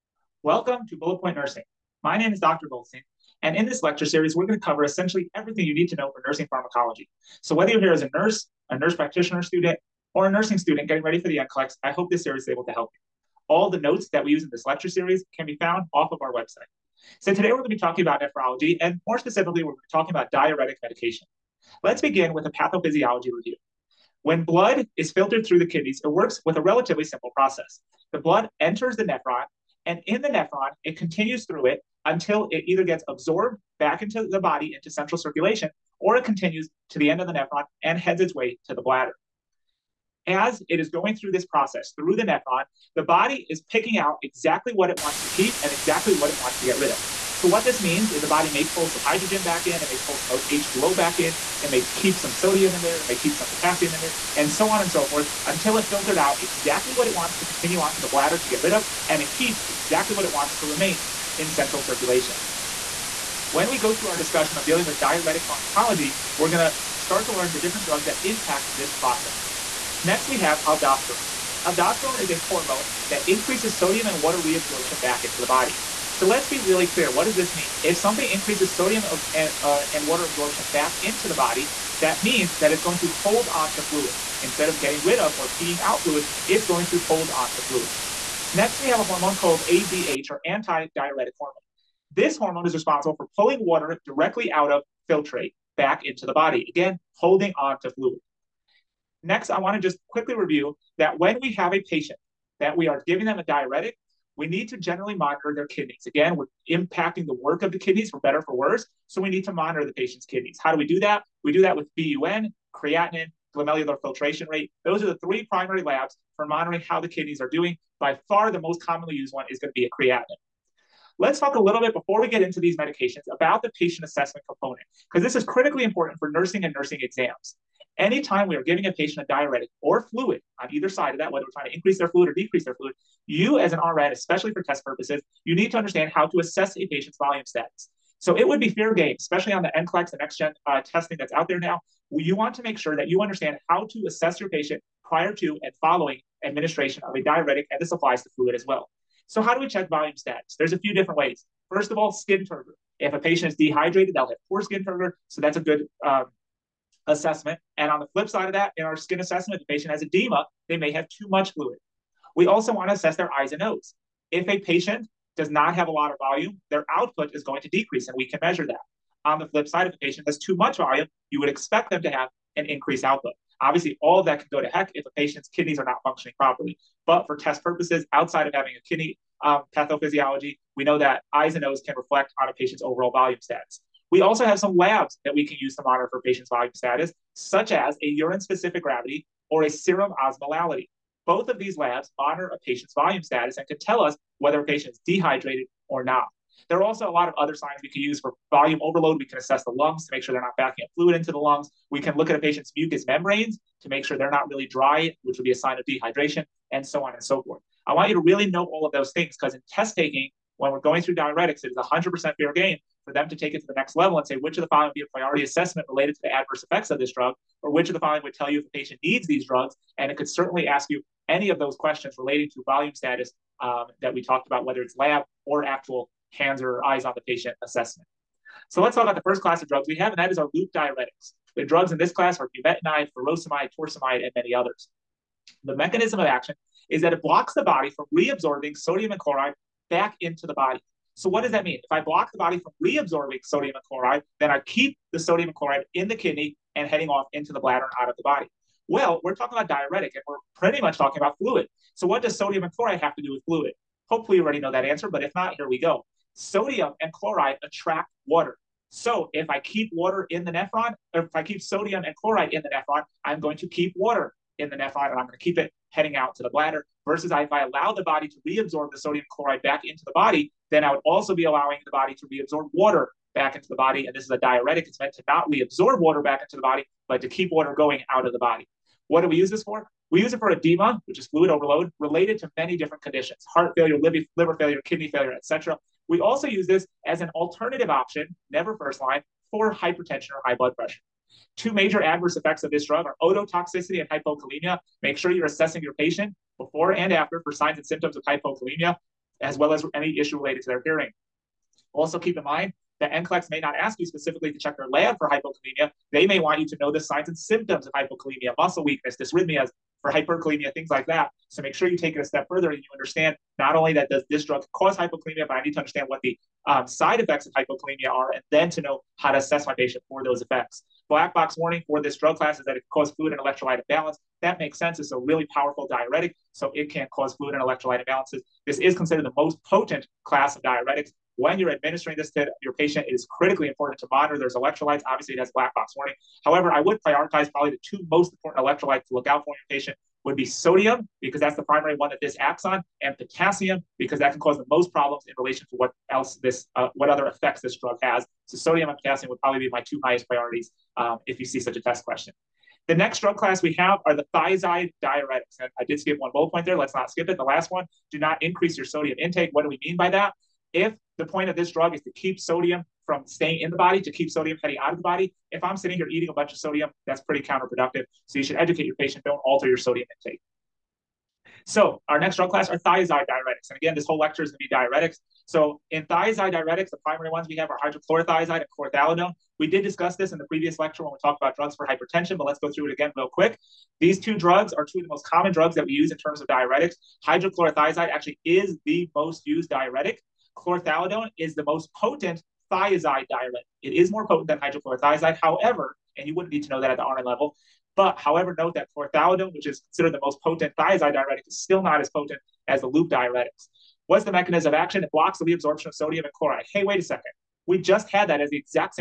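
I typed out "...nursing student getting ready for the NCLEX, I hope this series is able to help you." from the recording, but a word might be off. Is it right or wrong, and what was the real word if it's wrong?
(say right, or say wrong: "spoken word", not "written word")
right.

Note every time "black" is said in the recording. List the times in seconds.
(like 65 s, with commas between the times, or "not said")
321 s, 335 s.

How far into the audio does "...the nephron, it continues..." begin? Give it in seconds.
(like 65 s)
30 s.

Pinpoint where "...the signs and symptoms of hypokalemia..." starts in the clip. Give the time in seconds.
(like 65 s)
306 s.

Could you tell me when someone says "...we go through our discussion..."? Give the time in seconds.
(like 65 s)
63 s.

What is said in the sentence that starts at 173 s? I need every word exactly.
Obviously, all that can go to heck if a patient's kidneys are not functioning properly.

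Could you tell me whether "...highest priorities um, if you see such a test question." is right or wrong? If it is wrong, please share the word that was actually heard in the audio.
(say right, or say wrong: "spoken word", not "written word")
right.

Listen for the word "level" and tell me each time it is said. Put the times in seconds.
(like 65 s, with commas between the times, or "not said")
213 s, 397 s.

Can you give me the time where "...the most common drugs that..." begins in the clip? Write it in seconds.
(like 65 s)
385 s.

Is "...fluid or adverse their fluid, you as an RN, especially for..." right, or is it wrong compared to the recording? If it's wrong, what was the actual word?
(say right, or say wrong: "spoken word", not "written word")
wrong: "decrease", not "adverse".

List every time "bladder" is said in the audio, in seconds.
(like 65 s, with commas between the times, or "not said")
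38 s, 58 s, 247 s, 266 s.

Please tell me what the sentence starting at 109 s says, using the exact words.
So we need to monitor the patient's kidneys.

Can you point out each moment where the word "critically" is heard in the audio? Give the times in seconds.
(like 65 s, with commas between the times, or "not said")
125 s, 333 s.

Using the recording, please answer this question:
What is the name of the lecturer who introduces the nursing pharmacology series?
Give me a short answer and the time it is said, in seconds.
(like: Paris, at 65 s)
Dr. Goldstein, at 2 s.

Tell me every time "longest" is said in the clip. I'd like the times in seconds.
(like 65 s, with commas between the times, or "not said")
not said.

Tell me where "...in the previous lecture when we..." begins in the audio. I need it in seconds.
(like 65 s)
380 s.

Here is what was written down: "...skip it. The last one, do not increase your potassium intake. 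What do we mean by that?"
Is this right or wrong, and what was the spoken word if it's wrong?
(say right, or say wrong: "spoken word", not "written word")
wrong: "sodium", not "potassium".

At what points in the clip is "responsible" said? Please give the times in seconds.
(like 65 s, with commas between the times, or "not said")
92 s.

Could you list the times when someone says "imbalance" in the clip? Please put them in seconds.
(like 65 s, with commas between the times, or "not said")
323 s, 328 s.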